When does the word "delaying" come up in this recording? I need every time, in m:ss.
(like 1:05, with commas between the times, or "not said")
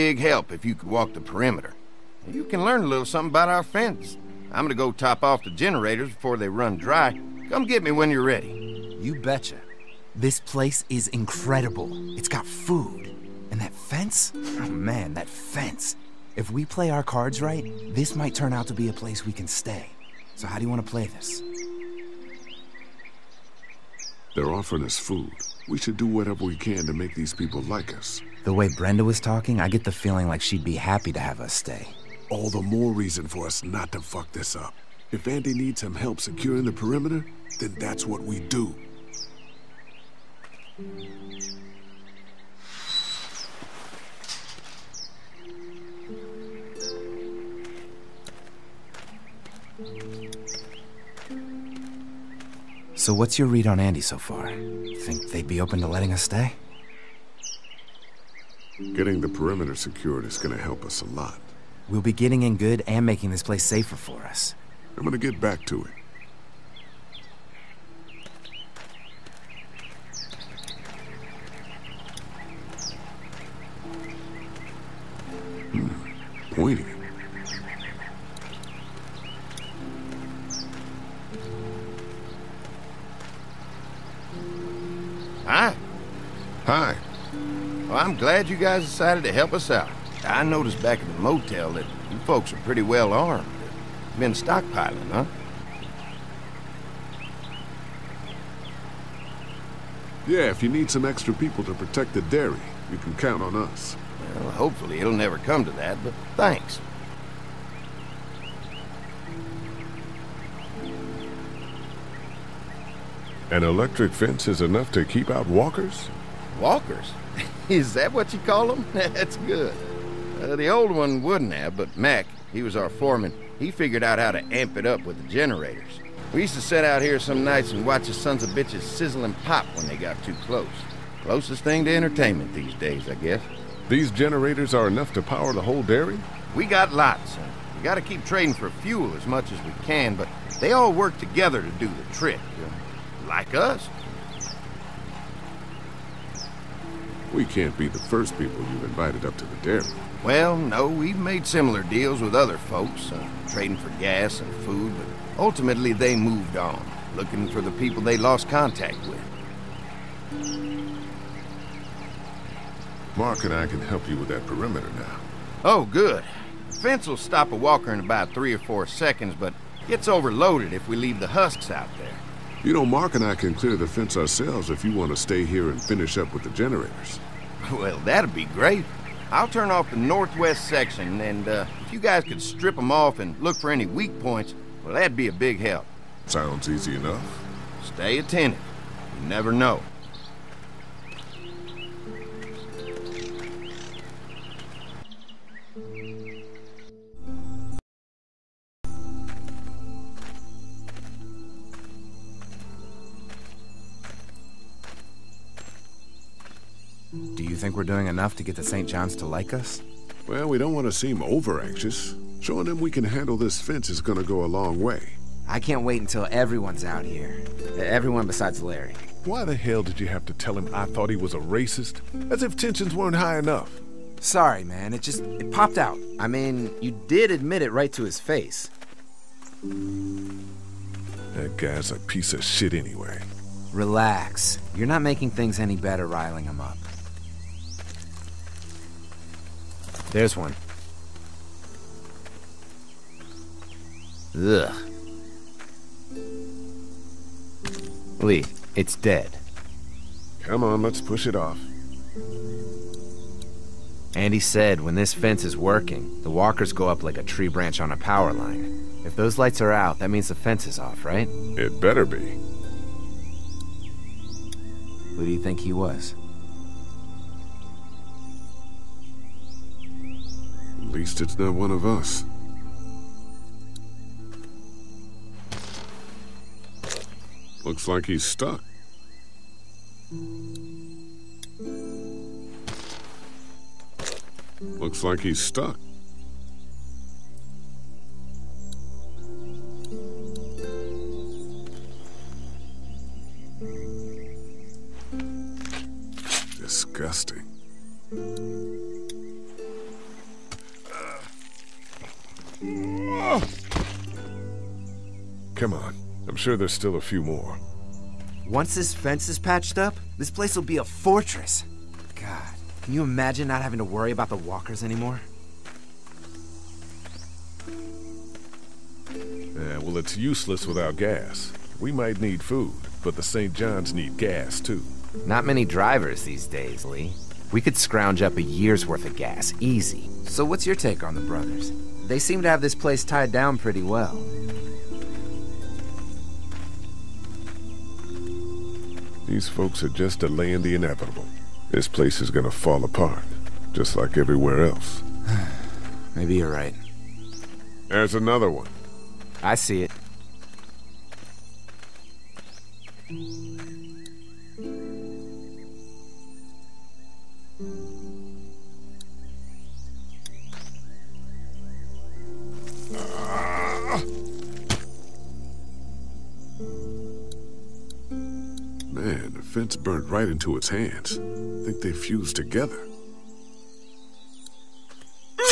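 5:40.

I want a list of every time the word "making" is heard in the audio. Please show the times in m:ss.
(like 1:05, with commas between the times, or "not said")
1:03, 3:55.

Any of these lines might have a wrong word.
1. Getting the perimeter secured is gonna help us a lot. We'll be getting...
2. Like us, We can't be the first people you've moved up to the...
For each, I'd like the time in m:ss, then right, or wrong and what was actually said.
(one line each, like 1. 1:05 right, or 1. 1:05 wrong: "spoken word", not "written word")
1. 0:58 right
2. 2:23 wrong: "invited", not "moved".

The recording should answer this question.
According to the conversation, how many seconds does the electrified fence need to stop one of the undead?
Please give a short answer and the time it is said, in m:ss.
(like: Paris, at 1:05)
3 or 4, at 2:48.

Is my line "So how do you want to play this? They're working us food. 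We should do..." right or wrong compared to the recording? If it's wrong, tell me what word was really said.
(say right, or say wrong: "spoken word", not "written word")
wrong: "offering", not "working".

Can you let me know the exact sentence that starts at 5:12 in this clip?
God, can you imagine not having to worry about the walkers anymore?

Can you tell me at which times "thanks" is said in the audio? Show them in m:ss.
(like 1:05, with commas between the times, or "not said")
1:46.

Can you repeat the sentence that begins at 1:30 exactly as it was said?
I noticed back at the motel that you folks are pretty well armed.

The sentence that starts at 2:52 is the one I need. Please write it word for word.
You know, Mark and I can clear the fence ourselves if you want to stay here and finish up with the generators.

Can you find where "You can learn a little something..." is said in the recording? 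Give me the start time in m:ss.
0:02.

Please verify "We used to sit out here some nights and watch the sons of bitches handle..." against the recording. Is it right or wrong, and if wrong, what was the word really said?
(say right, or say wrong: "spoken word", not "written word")
wrong: "sizzle", not "handle".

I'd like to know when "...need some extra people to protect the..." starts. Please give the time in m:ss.
1:40.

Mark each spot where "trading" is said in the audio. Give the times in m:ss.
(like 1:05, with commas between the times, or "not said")
2:18, 2:33.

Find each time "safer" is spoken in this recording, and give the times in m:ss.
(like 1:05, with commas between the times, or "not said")
1:03.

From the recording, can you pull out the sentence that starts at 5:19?
Yeah, well, it's useless without gas.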